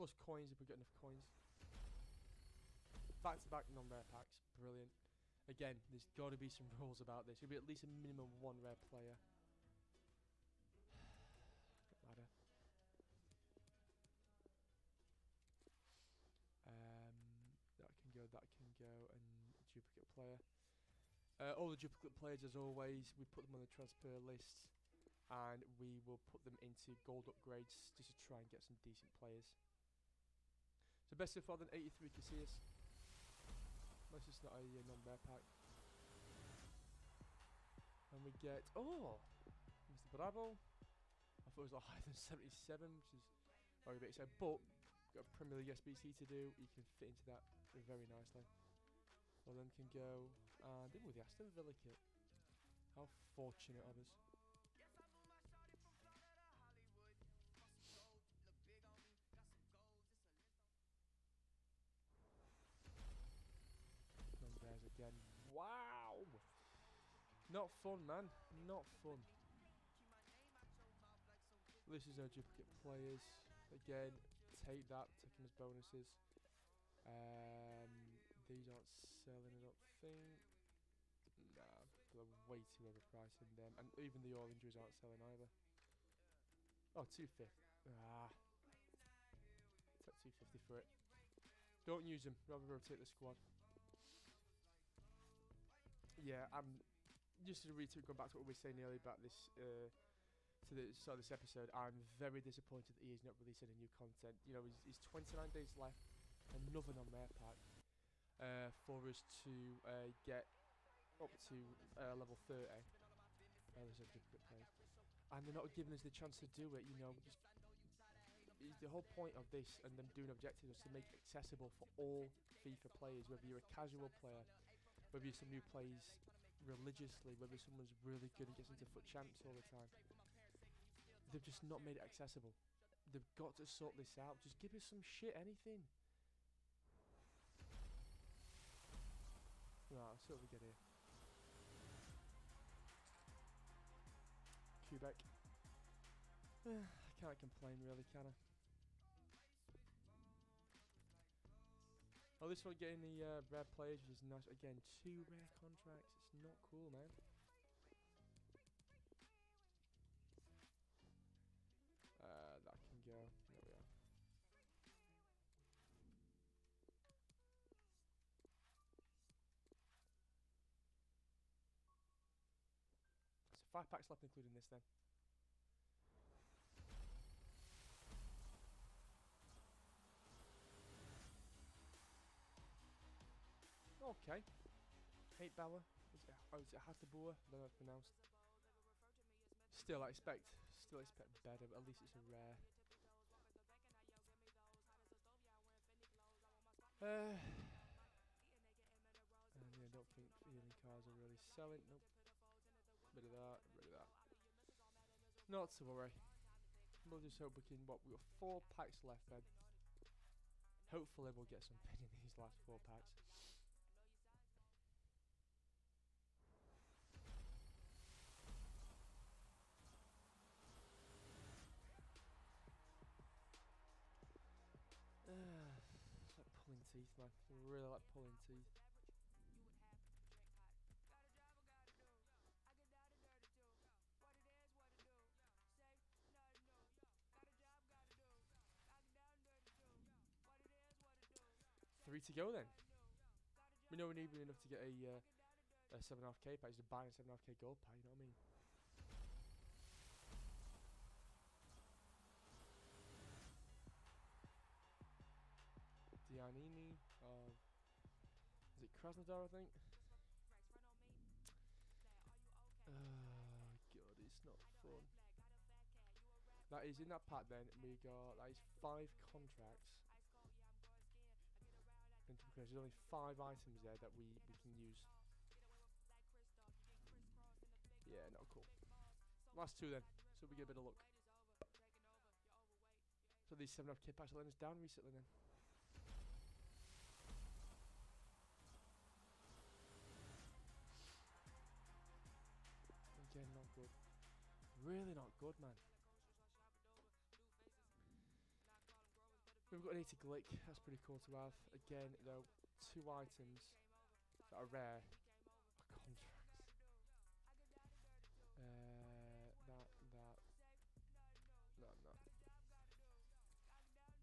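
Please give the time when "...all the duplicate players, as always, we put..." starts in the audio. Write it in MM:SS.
00:21.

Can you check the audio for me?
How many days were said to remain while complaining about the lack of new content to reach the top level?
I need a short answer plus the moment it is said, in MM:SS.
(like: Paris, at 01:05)
29, at 01:45.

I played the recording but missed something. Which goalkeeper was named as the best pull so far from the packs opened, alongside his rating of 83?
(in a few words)
Casillas.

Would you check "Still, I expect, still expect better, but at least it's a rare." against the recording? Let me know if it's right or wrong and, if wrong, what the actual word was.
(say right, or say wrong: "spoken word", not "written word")
right.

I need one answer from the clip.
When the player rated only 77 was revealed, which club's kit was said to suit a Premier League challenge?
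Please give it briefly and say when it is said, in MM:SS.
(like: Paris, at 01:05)
Aston Villa, at 00:51.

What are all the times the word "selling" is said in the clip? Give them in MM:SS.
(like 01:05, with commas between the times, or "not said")
01:19, 01:24, 03:21.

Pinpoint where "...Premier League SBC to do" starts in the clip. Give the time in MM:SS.
00:45.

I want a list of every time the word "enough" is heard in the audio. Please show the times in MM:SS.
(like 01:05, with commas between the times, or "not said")
00:00, 04:04.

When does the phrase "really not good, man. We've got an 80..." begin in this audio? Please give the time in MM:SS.
04:54.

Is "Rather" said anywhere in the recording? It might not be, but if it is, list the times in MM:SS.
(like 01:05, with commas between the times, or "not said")
01:32.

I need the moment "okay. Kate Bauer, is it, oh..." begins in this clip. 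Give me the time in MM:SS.
03:04.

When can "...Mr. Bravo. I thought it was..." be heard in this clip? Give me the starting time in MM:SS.
00:39.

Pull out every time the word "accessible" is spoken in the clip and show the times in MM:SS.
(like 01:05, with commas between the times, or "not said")
02:01, 02:12.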